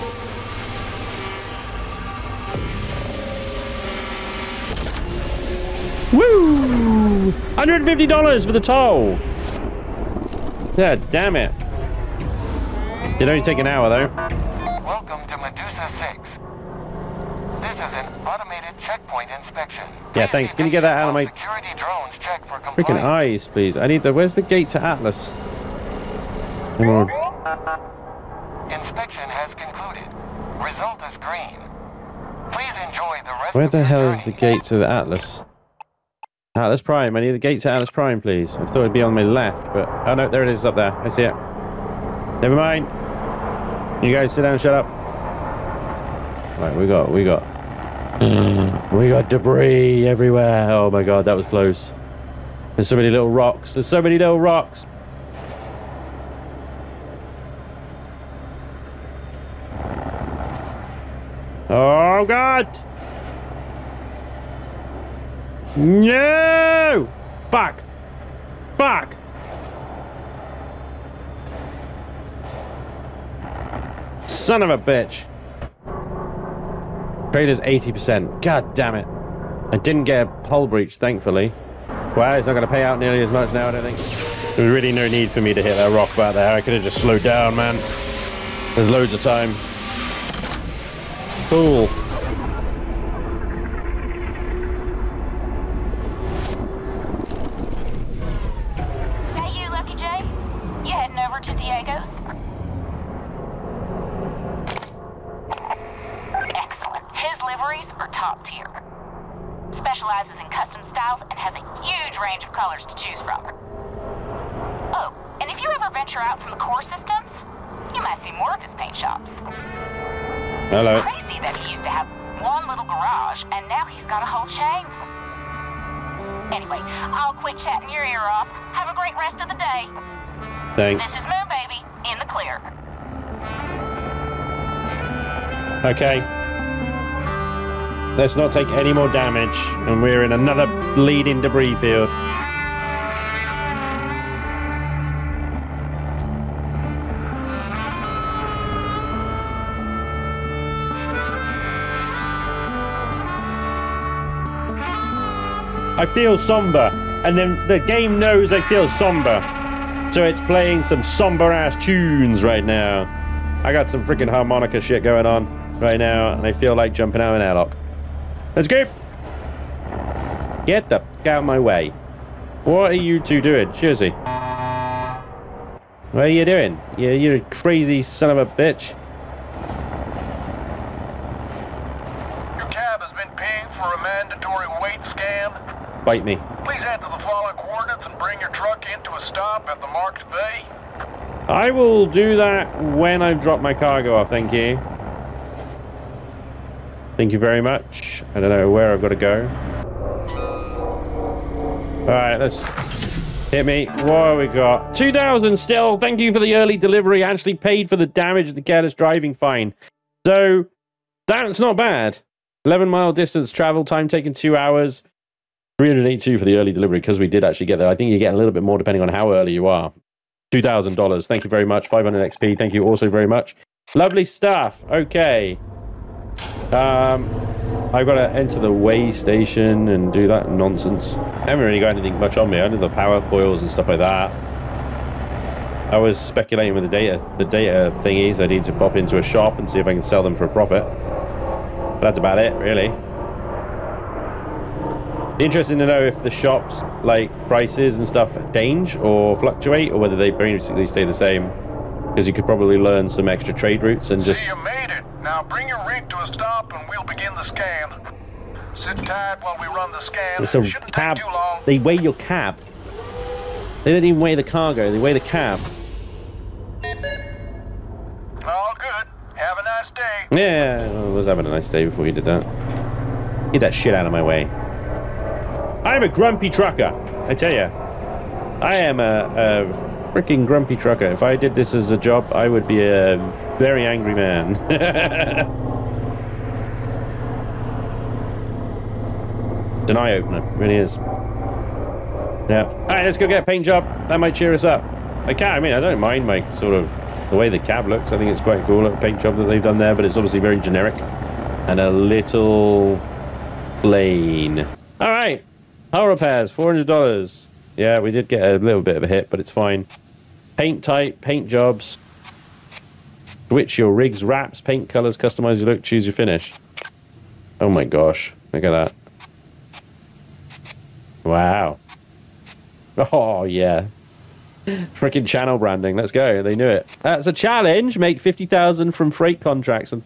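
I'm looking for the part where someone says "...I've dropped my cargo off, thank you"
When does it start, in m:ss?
3:13.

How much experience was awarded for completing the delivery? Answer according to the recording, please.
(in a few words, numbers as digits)
500 XP.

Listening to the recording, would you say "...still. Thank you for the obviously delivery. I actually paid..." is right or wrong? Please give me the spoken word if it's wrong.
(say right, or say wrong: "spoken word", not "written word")
wrong: "early", not "obviously".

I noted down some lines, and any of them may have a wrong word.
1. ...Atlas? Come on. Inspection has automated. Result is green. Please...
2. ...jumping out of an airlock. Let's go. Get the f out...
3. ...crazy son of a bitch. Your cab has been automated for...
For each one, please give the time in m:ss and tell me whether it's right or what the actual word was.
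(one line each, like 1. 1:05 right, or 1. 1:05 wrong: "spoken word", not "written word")
1. 0:24 wrong: "concluded", not "automated"
2. 2:46 right
3. 2:57 wrong: "pinged", not "automated".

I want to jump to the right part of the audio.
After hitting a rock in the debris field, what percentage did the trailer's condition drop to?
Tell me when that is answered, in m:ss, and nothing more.
1:17.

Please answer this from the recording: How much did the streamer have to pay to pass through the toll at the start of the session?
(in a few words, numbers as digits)
$150.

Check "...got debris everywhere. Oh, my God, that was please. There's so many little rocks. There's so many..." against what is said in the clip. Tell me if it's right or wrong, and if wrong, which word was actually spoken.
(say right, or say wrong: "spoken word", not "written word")
wrong: "close", not "please".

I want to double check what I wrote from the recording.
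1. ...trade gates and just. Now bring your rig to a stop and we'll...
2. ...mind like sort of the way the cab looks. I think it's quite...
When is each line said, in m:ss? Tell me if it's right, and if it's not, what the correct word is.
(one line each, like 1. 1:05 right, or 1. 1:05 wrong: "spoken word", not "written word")
1. 4:13 wrong: "routes", not "gates"
2. 4:55 right.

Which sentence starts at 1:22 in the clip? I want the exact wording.
Well, it's not going to pay out nearly as much now, I don't think.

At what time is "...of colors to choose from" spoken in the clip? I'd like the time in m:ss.
1:52.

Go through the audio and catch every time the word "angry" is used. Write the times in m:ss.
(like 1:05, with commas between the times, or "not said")
4:43.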